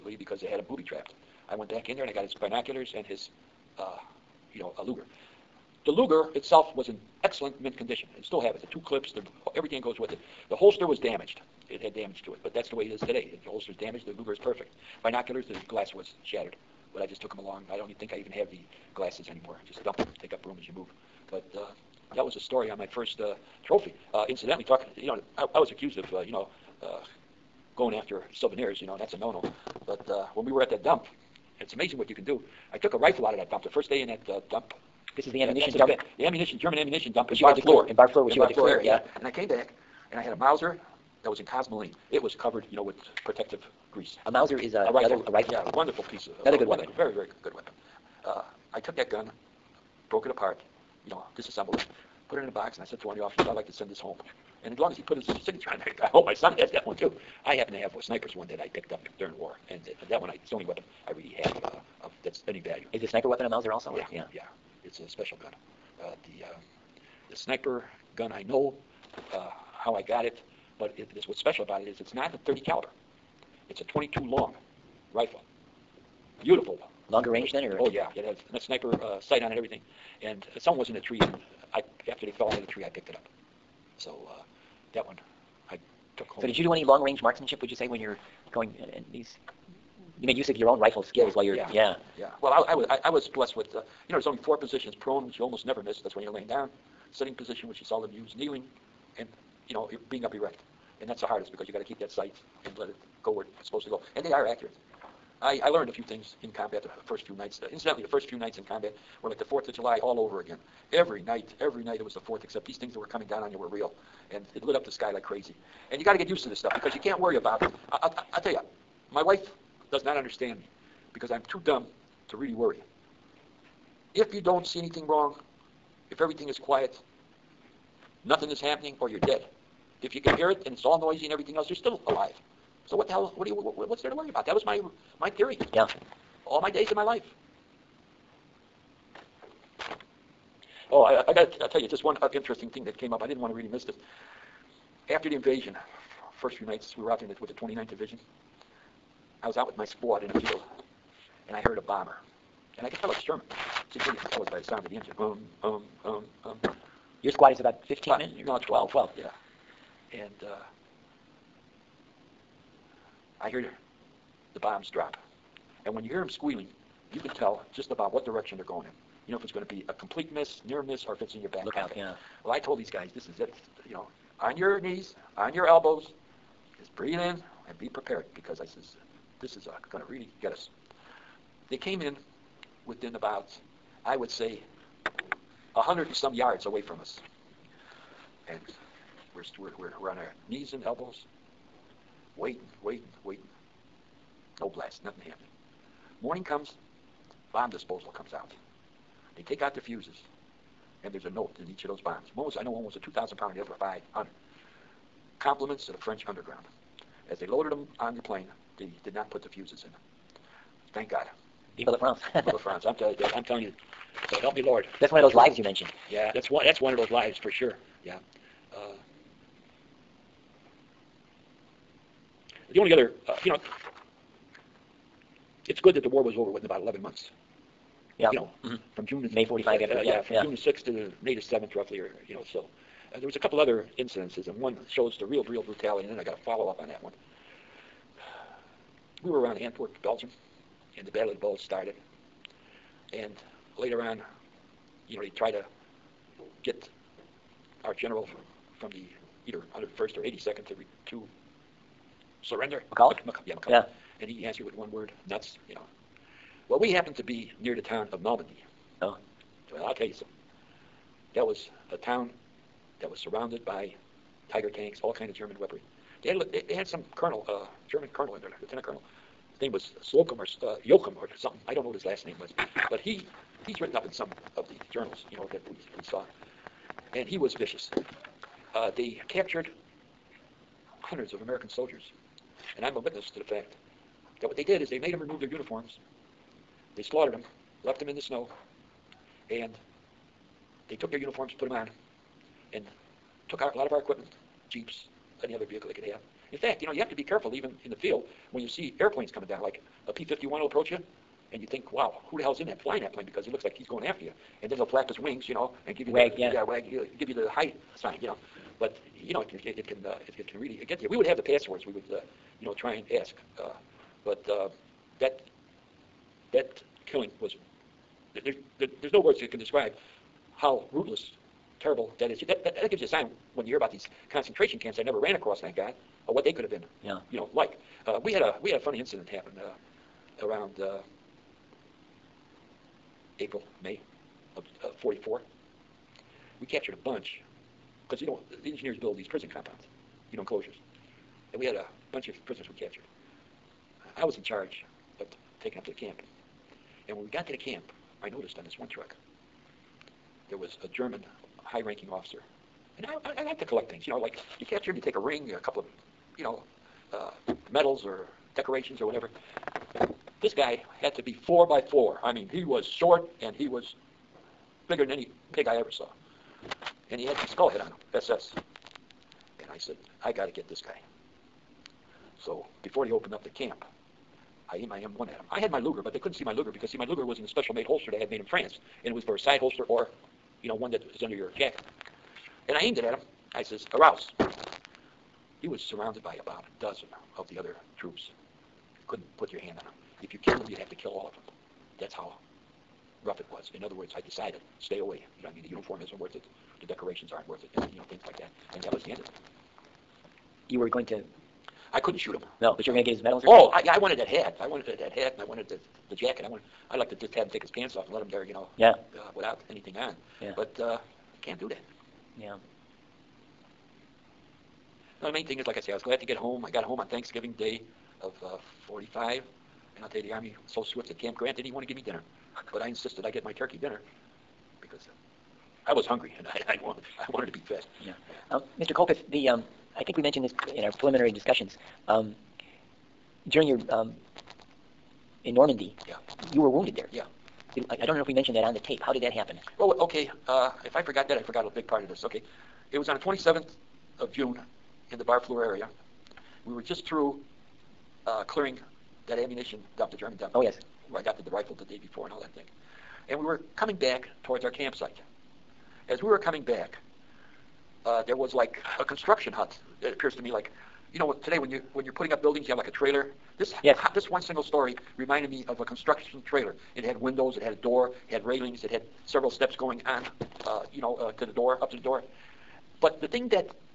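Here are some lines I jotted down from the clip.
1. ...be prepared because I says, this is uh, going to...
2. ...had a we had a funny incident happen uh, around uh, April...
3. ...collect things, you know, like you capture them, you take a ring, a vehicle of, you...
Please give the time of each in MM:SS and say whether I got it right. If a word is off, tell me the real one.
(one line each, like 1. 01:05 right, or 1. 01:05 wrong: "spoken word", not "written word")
1. 02:57 right
2. 05:28 right
3. 05:53 wrong: "couple", not "vehicle".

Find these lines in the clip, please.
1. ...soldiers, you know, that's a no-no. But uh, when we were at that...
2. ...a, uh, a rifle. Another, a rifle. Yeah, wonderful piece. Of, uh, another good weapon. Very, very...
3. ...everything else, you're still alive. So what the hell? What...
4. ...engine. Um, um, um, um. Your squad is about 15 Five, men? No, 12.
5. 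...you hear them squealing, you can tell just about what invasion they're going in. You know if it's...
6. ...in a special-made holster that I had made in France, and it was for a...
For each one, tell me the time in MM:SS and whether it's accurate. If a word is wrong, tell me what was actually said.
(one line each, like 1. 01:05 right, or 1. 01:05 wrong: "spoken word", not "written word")
1. 00:28 wrong: "souvenirs", not "soldiers"
2. 00:44 right
3. 02:11 right
4. 02:34 right
5. 02:46 wrong: "direction", not "invasion"
6. 06:17 right.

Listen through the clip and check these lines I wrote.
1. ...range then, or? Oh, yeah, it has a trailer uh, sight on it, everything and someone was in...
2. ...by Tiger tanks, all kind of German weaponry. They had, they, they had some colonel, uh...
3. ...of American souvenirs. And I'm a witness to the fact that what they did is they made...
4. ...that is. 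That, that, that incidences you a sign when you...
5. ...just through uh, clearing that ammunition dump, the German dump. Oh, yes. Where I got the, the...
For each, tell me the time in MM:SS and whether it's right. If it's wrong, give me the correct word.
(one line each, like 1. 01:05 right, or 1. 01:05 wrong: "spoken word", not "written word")
1. 01:17 wrong: "sniper", not "trailer"
2. 04:23 right
3. 04:41 wrong: "soldiers", not "souvenirs"
4. 05:22 wrong: "gives", not "incidences"
5. 07:26 right.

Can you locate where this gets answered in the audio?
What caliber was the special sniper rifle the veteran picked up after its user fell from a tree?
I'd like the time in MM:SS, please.
01:13.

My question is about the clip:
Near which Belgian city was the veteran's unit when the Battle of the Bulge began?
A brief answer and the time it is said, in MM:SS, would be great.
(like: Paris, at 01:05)
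Antwerp, at 03:59.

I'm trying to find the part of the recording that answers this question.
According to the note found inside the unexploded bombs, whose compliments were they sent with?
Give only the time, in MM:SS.
03:25.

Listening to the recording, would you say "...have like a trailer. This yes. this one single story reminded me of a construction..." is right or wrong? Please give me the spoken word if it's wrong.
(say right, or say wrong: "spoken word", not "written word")
right.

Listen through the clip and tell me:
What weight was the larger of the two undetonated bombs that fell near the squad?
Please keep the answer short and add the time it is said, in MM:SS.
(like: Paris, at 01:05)
2,000 pound, at 03:22.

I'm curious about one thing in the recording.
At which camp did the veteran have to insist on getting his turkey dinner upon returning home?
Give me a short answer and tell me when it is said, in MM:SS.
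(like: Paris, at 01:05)
Camp Grant, at 07:01.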